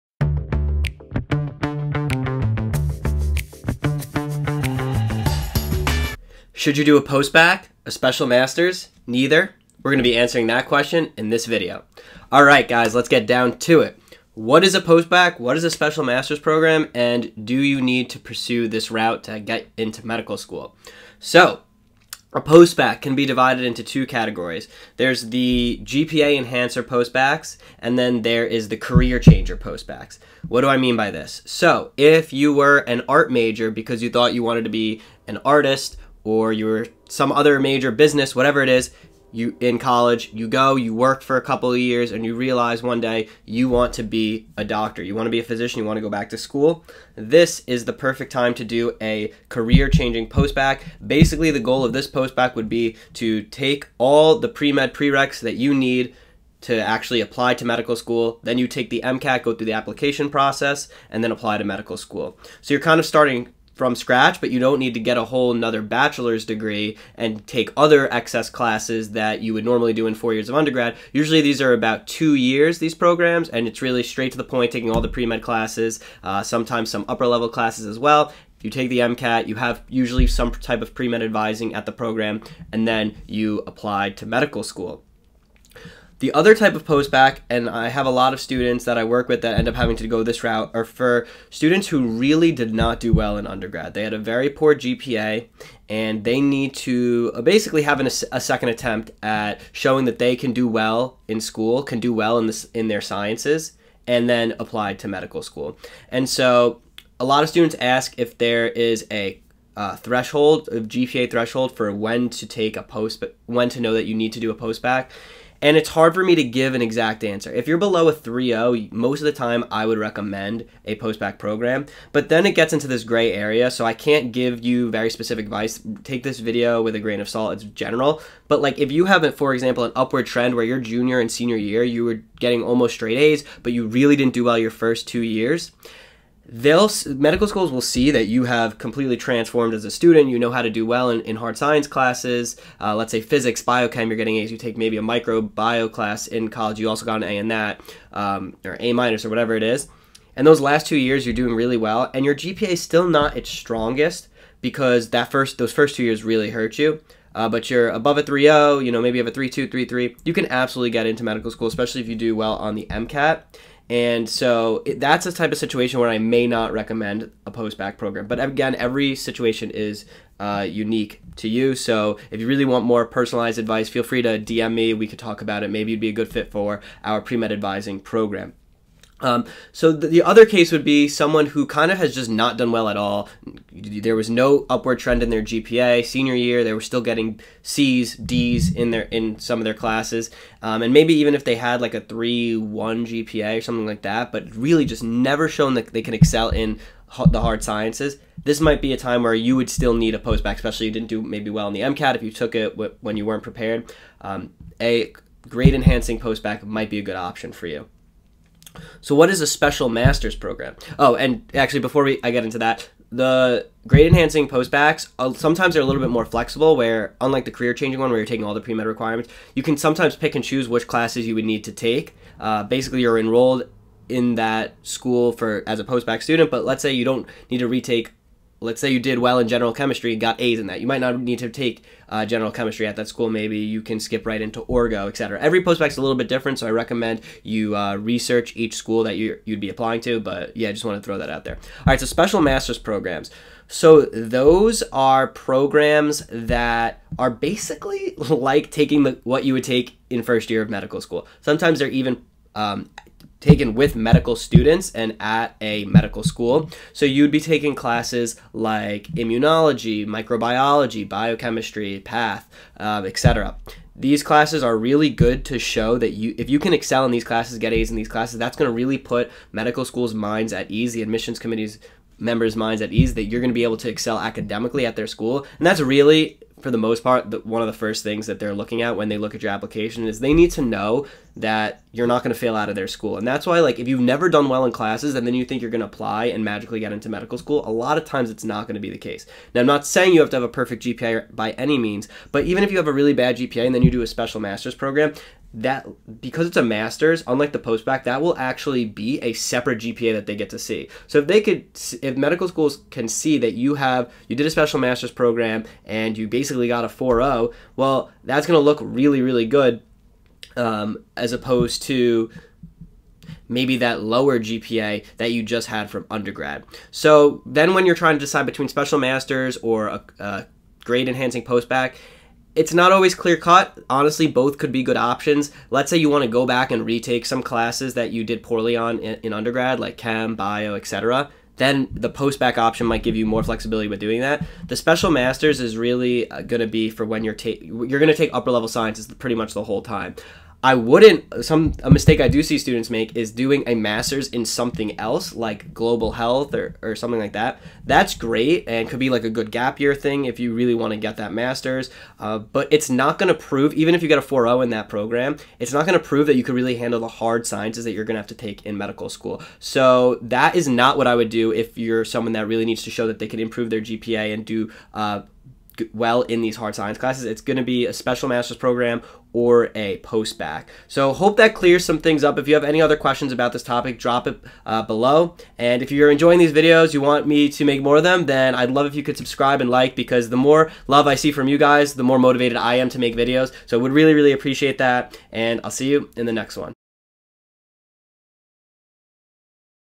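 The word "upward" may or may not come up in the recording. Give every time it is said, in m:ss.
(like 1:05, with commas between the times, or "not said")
2:09, 3:04.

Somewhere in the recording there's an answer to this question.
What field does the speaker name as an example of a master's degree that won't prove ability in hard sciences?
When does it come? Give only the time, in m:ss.
5:45.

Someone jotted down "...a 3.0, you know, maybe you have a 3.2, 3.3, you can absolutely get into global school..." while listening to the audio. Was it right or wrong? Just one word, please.
wrong.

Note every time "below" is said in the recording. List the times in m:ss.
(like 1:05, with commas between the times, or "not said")
1:57, 6:14.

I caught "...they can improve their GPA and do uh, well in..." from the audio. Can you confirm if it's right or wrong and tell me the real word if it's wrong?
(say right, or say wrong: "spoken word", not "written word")
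right.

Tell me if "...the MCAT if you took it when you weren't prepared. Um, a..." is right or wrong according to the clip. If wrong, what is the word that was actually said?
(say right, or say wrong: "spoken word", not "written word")
right.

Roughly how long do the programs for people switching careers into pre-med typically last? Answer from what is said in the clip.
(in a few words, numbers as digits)
About 2 years.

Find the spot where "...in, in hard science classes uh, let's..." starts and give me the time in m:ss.
2:21.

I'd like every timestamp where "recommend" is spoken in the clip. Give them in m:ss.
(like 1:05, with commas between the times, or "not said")
1:59, 2:46, 3:56.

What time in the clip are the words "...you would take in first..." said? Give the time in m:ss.
4:09.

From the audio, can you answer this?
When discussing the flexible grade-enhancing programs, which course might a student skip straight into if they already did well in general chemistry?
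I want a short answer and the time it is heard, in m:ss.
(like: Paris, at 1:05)
Orgo, at 3:54.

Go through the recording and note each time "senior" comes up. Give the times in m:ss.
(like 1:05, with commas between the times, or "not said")
2:11, 3:06.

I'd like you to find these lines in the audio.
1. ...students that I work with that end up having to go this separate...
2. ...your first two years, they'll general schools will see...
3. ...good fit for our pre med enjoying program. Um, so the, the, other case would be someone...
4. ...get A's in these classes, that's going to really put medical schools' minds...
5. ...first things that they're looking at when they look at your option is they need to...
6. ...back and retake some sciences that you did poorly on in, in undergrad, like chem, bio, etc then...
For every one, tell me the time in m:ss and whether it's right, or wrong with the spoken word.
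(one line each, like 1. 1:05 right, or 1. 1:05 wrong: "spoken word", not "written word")
1. 1:28 wrong: "route", not "separate"
2. 2:14 wrong: "medical", not "general"
3. 2:56 wrong: "advising", not "enjoying"
4. 4:27 right
5. 4:37 wrong: "application", not "option"
6. 5:26 wrong: "classes", not "sciences".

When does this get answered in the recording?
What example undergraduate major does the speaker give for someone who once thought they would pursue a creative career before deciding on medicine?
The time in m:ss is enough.
0:33.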